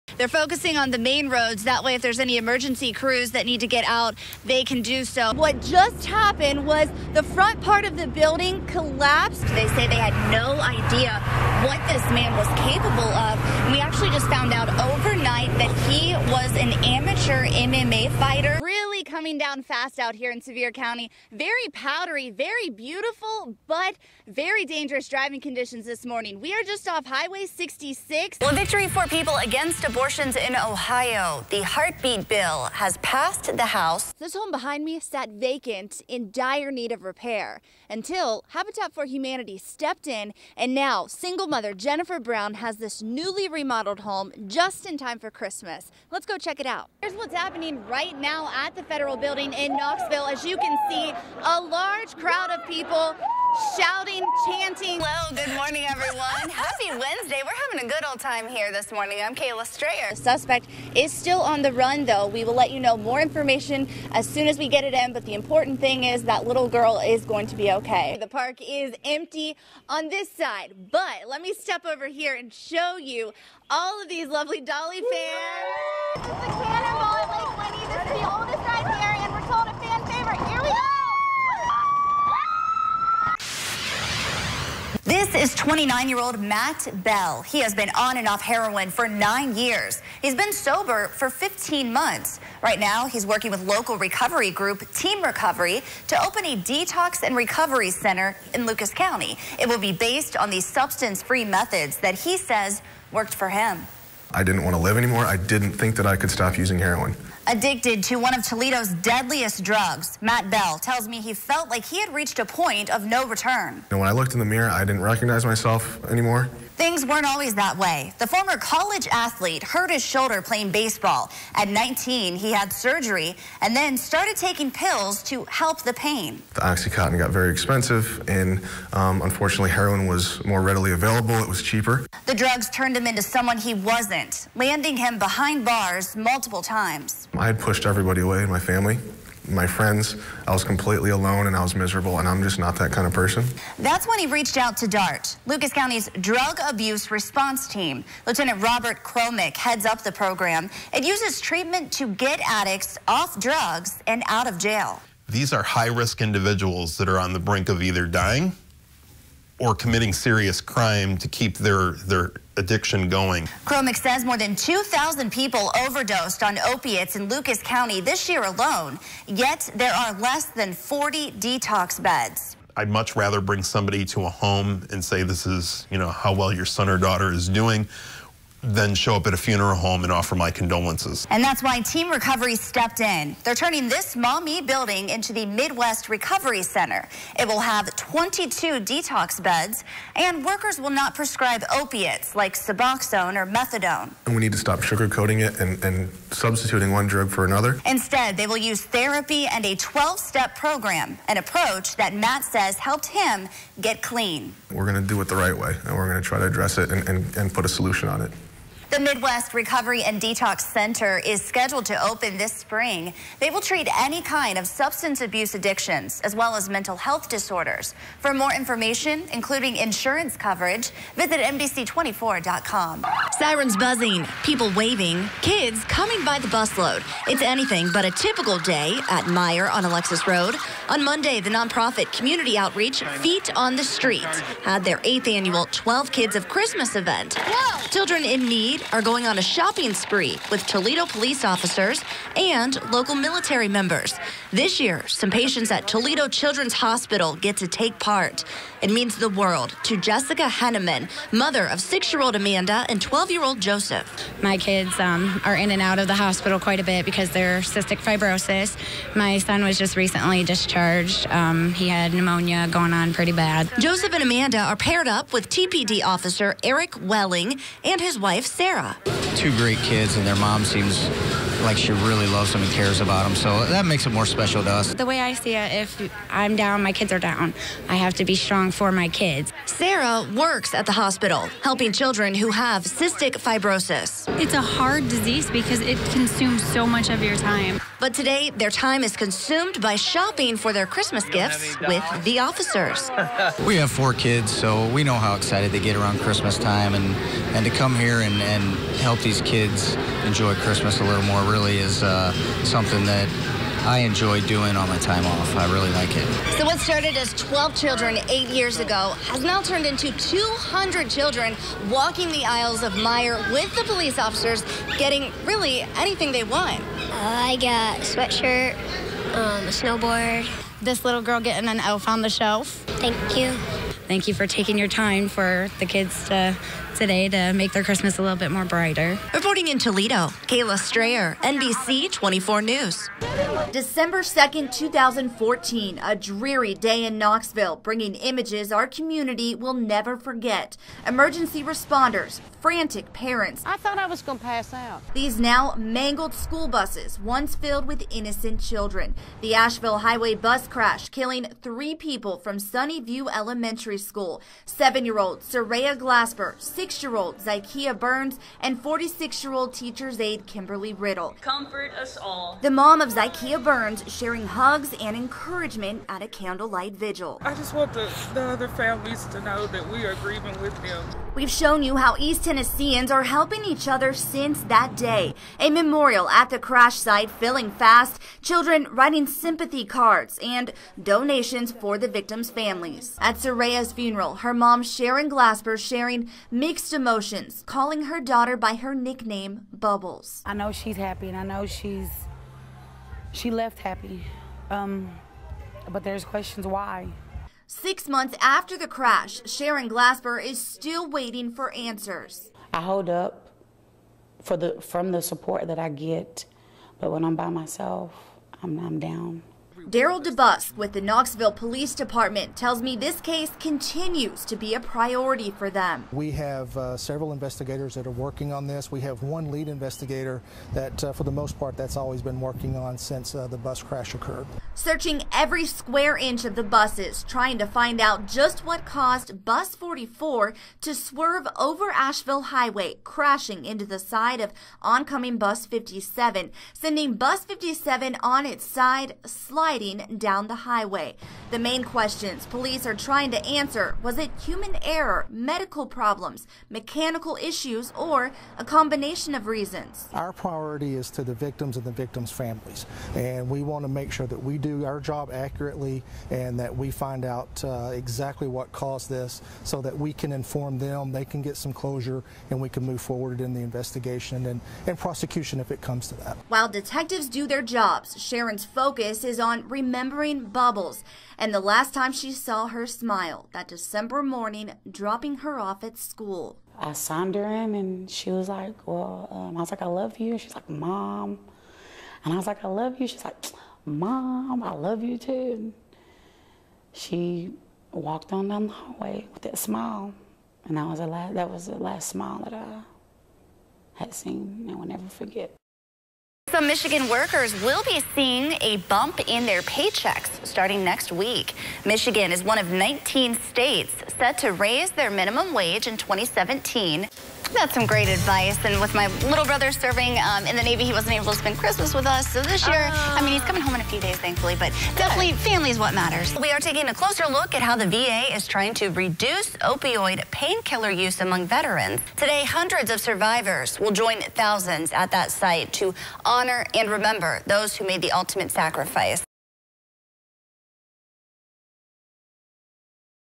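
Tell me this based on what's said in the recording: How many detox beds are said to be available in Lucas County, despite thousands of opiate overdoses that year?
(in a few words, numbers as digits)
less than 40.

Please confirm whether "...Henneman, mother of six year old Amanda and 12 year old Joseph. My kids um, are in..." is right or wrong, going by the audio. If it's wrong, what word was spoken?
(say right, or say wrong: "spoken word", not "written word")
right.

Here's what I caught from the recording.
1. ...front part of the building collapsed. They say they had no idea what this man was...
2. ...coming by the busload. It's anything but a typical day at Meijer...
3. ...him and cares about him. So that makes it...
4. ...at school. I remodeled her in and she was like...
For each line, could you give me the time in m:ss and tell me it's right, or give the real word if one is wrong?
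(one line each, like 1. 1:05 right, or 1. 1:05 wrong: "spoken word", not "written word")
1. 0:07 right
2. 3:45 right
3. 4:32 right
4. 7:55 wrong: "signed", not "remodeled".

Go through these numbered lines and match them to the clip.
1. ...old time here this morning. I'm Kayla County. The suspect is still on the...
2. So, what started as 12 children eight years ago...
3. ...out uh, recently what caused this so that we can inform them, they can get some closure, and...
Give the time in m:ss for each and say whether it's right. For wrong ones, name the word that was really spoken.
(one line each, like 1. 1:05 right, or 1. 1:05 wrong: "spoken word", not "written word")
1. 0:58 wrong: "Strayer", not "County"
2. 5:06 right
3. 7:37 wrong: "exactly", not "recently".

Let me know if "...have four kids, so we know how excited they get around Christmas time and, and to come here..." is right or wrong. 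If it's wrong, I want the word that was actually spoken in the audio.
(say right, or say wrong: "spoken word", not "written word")
right.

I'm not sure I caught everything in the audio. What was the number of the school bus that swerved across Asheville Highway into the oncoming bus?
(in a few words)
44.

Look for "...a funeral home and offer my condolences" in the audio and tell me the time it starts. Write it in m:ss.
2:59.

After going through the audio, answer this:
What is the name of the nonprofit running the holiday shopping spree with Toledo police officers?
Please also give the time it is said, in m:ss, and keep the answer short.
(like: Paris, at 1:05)
Feet on the Street, at 3:53.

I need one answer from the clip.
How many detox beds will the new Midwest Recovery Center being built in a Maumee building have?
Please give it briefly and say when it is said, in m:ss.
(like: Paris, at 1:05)
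22, at 3:07.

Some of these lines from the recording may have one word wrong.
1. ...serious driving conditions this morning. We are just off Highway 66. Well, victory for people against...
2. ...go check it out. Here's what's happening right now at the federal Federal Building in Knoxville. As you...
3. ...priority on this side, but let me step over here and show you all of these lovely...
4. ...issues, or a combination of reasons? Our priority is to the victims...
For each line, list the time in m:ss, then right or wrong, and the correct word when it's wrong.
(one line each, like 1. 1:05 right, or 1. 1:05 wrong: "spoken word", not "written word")
1. 0:24 wrong: "dangerous", not "serious"
2. 0:46 right
3. 1:09 wrong: "empty", not "priority"
4. 7:27 right.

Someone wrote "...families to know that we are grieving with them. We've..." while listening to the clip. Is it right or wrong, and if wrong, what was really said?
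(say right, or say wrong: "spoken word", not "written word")
right.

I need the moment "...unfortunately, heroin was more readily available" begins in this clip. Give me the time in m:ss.
2:09.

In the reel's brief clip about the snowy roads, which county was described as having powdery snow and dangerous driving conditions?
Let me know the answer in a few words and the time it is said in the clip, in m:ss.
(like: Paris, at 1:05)
Sevier County, at 0:20.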